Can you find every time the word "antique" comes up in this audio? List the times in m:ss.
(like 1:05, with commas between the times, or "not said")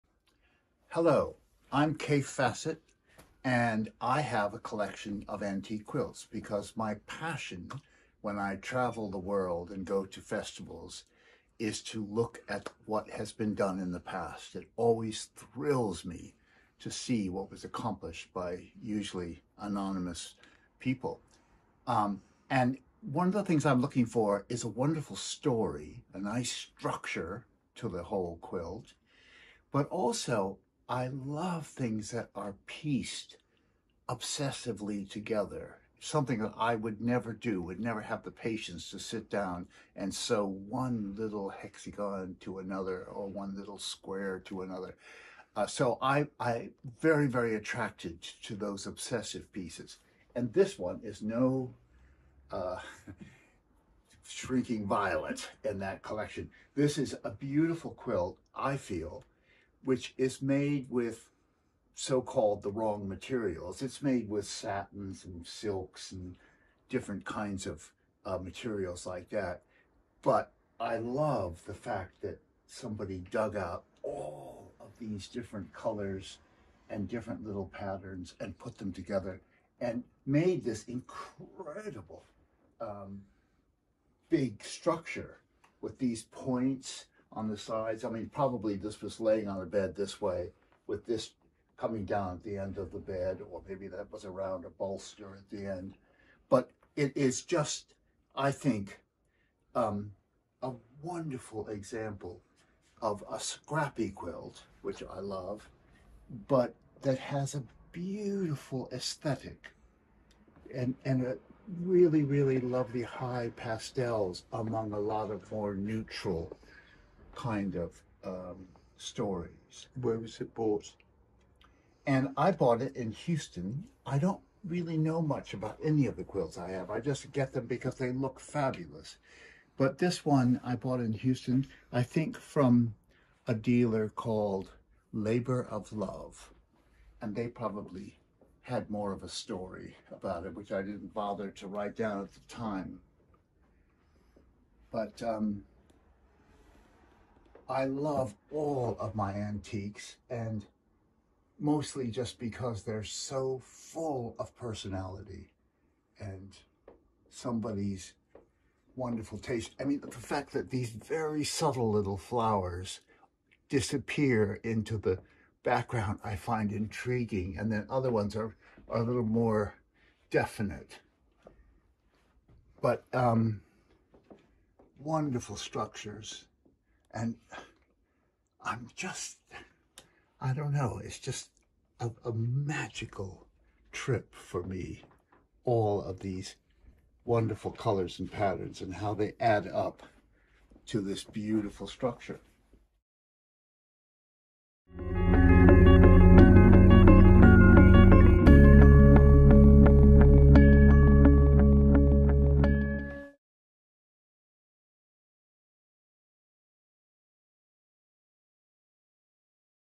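0:05, 2:29.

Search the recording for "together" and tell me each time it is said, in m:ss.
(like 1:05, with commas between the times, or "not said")
0:35, 1:18.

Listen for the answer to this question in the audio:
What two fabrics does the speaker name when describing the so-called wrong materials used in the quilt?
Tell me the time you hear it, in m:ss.
1:04.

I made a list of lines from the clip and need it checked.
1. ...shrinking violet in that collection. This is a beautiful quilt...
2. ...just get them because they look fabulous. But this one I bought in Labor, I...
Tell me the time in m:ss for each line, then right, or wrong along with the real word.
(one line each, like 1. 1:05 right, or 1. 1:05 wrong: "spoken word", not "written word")
1. 0:54 right
2. 2:06 wrong: "Houston", not "Labor".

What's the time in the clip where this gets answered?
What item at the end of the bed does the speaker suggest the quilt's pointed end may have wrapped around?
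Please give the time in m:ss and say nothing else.
1:34.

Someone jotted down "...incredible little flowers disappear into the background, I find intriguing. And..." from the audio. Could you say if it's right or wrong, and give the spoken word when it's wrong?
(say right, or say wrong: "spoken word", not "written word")
wrong: "subtle", not "incredible".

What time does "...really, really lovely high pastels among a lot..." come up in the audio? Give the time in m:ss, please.
1:51.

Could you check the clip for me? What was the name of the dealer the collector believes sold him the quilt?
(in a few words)
Labor of Love.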